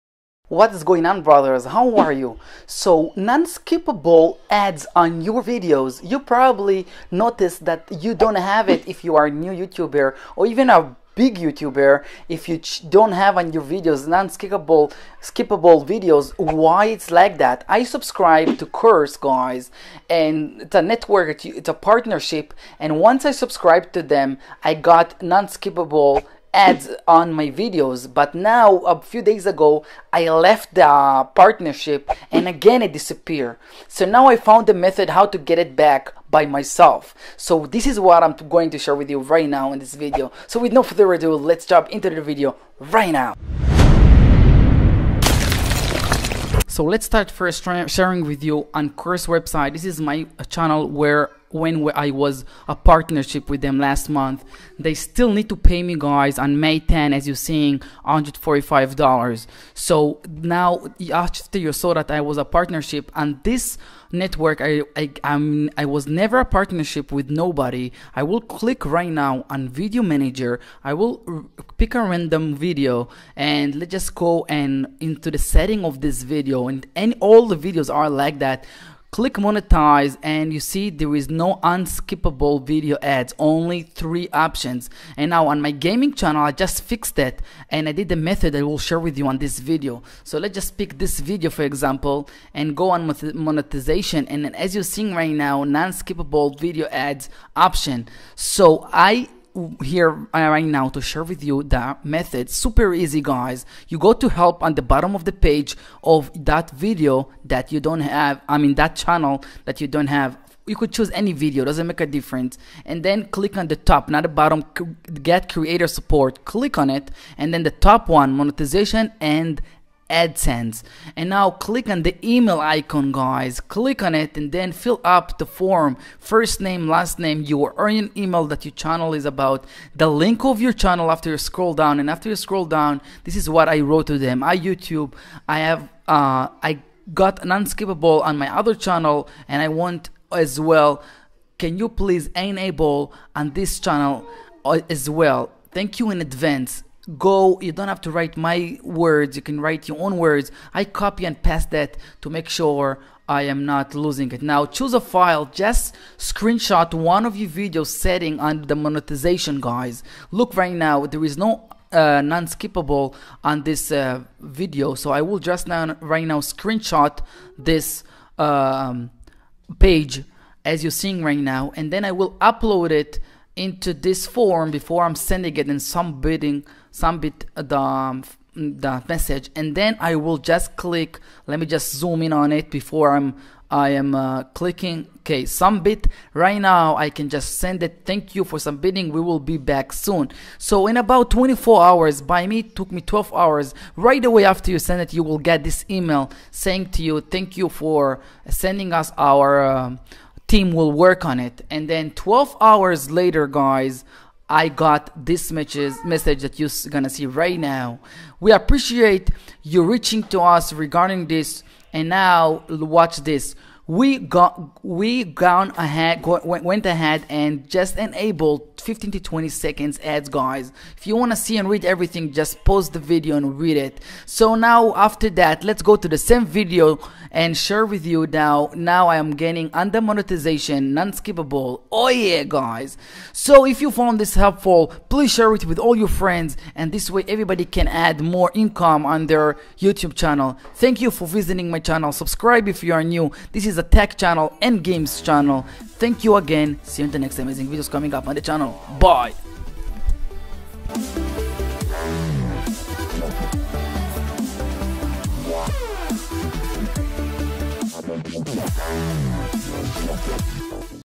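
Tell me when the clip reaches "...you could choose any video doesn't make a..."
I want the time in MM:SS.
01:50.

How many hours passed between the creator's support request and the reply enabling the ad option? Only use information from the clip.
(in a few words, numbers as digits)
12.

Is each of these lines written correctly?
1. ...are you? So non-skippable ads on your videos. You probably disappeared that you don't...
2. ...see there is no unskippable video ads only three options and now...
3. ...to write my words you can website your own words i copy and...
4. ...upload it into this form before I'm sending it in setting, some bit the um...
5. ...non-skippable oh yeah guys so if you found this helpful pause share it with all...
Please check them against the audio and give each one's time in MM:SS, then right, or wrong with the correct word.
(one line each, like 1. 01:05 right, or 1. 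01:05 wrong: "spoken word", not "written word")
1. 00:01 wrong: "noticed", not "disappeared"
2. 01:20 right
3. 02:28 wrong: "write", not "website"
4. 02:52 wrong: "bidding", not "setting"
5. 03:50 wrong: "please", not "pause".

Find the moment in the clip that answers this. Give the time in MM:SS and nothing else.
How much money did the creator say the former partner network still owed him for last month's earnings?
00:58.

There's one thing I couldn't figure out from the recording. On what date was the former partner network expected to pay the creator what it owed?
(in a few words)
May 10.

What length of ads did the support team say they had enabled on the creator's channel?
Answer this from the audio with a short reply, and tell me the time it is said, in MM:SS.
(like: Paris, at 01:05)
15 to 20 seconds, at 03:38.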